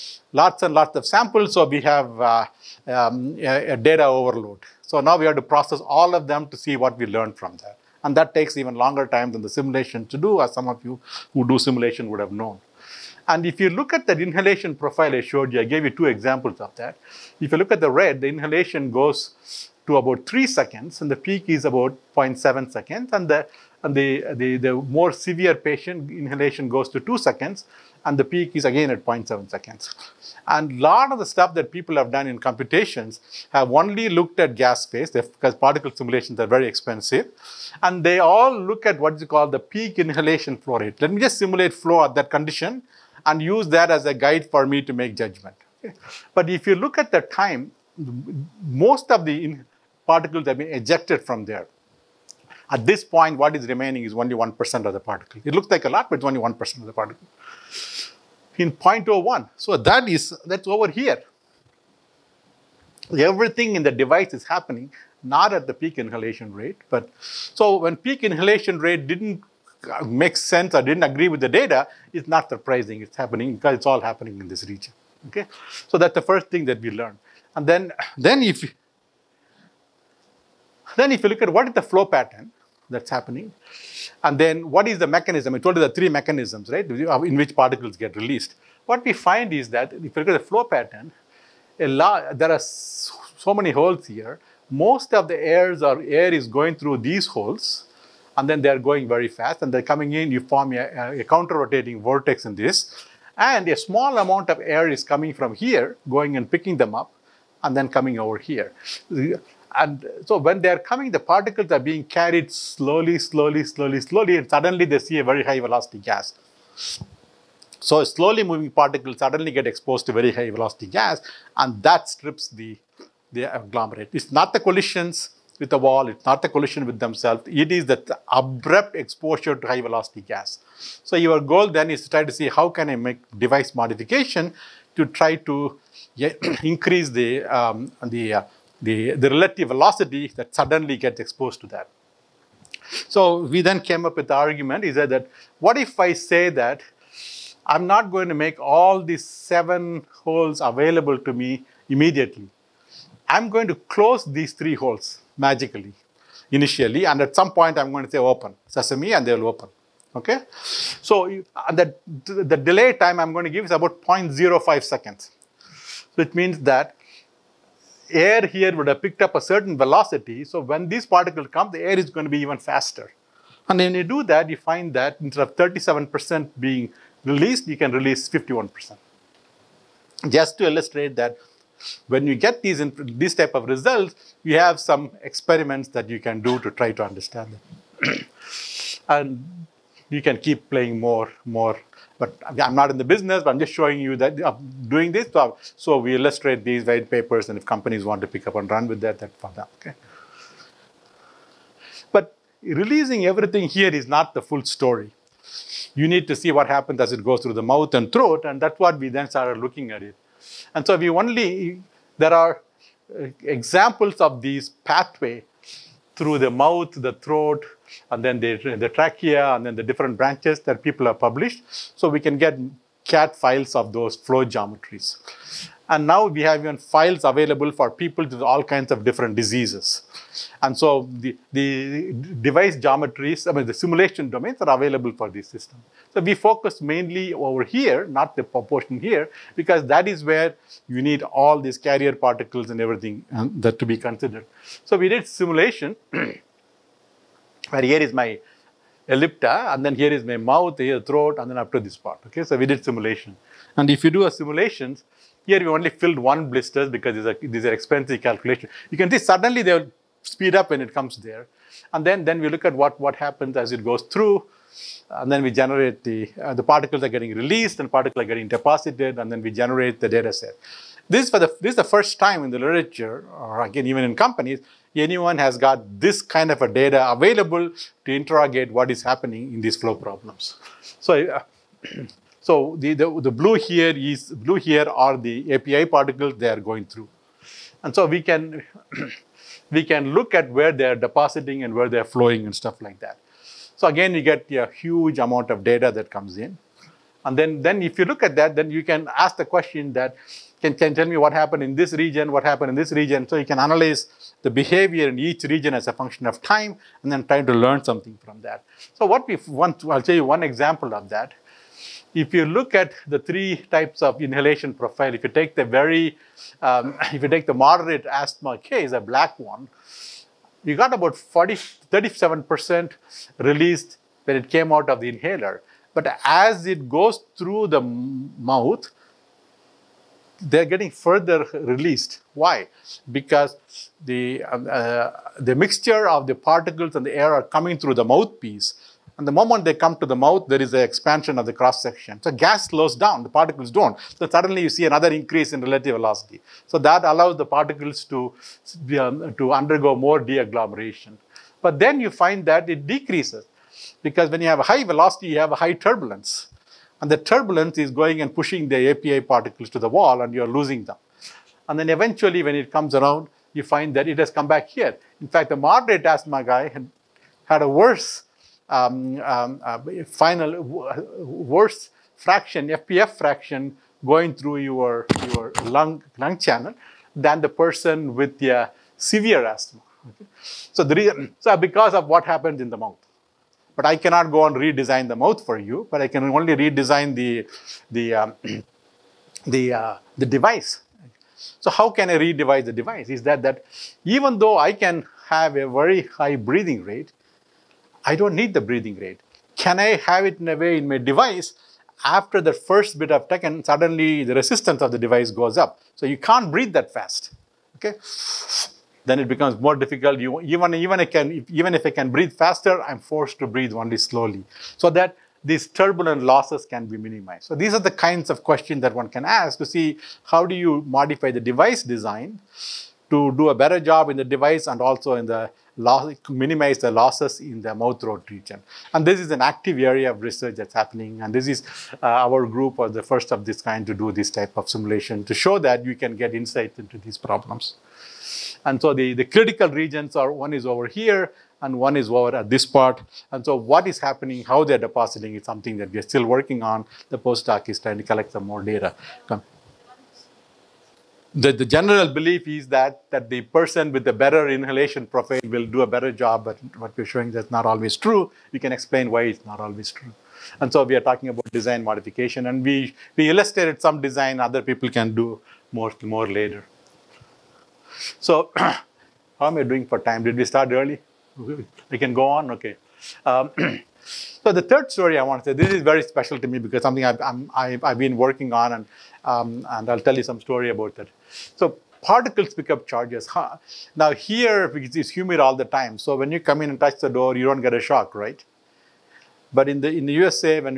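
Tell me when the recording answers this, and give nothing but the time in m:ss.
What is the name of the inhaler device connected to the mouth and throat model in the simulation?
4:09.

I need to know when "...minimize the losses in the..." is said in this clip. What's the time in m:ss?
7:06.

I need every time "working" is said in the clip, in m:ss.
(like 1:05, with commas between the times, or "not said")
7:26, 7:58.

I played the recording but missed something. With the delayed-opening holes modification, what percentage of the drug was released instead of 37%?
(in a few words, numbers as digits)
51%.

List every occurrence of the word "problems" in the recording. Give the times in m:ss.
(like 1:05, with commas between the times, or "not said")
4:39, 7:17.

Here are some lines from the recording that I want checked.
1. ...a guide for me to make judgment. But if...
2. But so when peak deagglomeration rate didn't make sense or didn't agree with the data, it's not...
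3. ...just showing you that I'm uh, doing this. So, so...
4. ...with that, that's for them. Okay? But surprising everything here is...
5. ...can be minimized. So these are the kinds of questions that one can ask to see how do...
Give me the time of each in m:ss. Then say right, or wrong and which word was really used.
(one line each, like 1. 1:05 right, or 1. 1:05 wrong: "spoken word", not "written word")
1. 0:44 right
2. 1:06 wrong: "inhalation", not "deagglomeration"
3. 3:13 right
4. 3:18 wrong: "releasing", not "surprising"
5. 6:56 right.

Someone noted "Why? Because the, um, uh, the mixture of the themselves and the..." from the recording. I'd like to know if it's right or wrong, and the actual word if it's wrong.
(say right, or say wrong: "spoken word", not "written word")
wrong: "particles", not "themselves".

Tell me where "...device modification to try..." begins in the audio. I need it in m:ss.
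2:13.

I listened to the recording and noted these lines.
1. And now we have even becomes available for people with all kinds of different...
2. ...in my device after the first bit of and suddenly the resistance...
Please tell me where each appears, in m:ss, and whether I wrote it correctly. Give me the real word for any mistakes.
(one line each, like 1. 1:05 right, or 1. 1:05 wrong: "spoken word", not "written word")
1. 3:45 wrong: "files", not "becomes"
2. 6:40 right.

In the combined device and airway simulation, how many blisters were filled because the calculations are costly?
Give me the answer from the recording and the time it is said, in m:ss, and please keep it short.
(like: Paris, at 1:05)
1, at 4:16.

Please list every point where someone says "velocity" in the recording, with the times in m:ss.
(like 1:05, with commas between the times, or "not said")
1:55, 2:00, 2:09, 2:19, 2:49, 5:45, 5:54.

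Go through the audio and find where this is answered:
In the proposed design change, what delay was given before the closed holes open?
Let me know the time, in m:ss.
2:44.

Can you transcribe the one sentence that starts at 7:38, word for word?
We can explain why it's not always true.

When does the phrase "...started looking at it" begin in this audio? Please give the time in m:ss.
3:29.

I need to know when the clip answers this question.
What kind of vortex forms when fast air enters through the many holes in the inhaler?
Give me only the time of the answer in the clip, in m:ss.
1:41.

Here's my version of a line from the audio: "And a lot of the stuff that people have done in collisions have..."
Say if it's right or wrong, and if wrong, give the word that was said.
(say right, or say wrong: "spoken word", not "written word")
wrong: "computations", not "collisions".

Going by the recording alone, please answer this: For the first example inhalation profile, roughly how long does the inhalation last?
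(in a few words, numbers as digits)
3 seconds.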